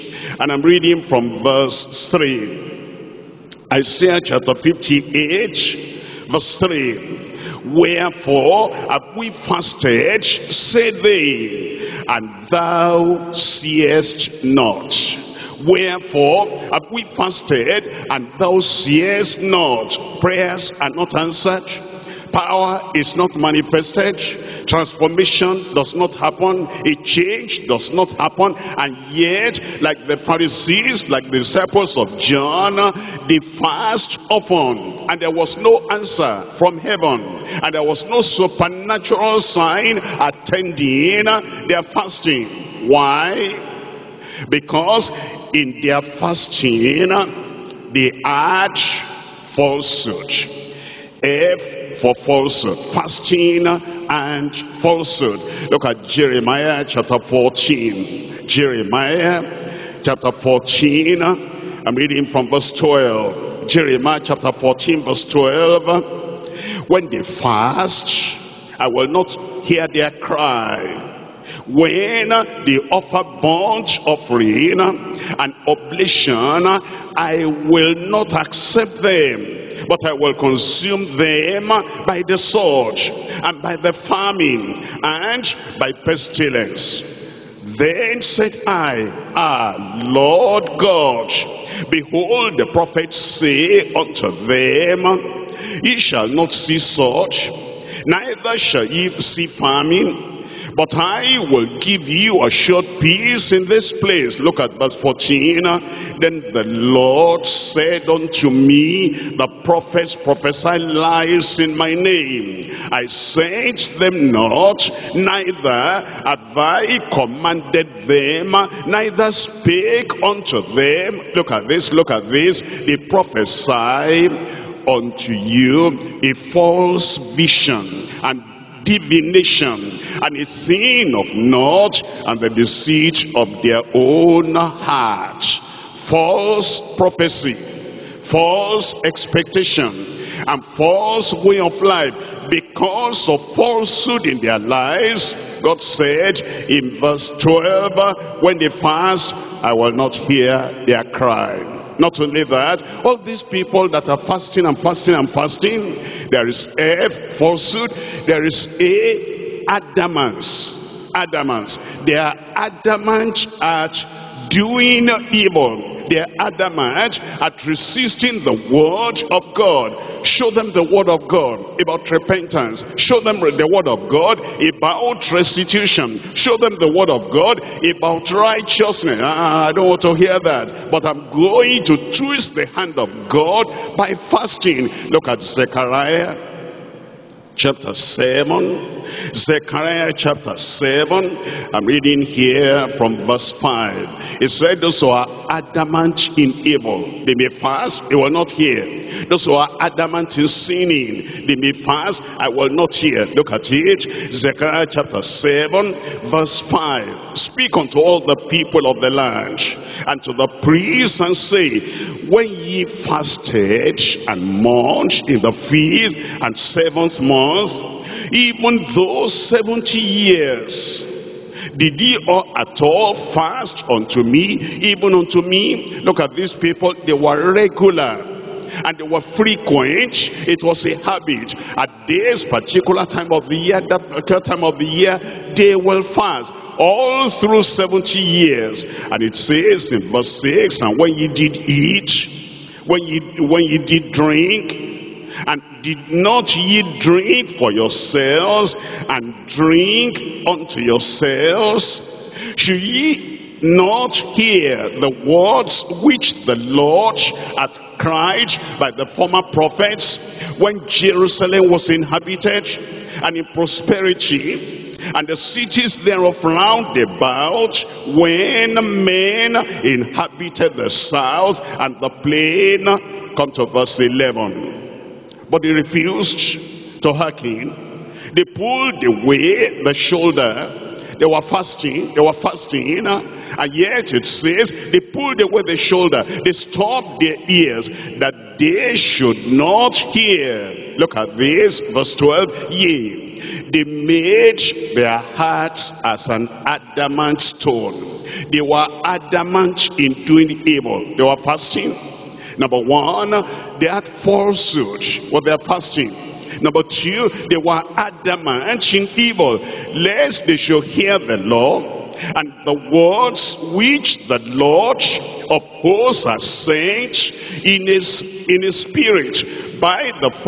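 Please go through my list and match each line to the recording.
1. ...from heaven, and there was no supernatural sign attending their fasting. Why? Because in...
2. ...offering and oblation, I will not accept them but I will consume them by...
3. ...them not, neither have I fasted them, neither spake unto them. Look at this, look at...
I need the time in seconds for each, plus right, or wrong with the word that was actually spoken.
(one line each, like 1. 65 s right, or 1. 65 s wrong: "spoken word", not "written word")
1. 36 s right
2. 74 s right
3. 113 s wrong: "commanded", not "fasted".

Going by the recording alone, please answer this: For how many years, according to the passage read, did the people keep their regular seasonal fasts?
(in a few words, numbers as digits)
70.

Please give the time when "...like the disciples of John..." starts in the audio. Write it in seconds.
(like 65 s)
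31 s.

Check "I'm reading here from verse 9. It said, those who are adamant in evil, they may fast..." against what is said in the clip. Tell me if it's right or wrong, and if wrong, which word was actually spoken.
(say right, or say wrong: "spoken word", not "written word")
wrong: "5", not "9".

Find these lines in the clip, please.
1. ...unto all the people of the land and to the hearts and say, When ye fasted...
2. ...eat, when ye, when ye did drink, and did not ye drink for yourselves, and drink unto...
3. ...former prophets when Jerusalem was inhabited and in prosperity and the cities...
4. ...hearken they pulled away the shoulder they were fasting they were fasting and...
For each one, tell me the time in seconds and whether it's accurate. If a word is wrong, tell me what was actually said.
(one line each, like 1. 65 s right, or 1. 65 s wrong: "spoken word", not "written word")
1. 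207 s wrong: "priests", not "hearts"
2. 241 s right
3. 259 s right
4. 277 s right.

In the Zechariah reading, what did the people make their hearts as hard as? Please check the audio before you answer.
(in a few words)
an adamant stone.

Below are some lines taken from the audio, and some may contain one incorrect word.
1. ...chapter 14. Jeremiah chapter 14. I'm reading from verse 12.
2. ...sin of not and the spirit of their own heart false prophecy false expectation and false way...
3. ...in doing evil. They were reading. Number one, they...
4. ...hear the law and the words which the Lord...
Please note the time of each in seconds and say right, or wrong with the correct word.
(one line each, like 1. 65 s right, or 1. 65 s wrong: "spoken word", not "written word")
1. 56 s right
2. 130 s wrong: "deceit", not "spirit"
3. 299 s wrong: "fasting", not "reading"
4. 310 s right.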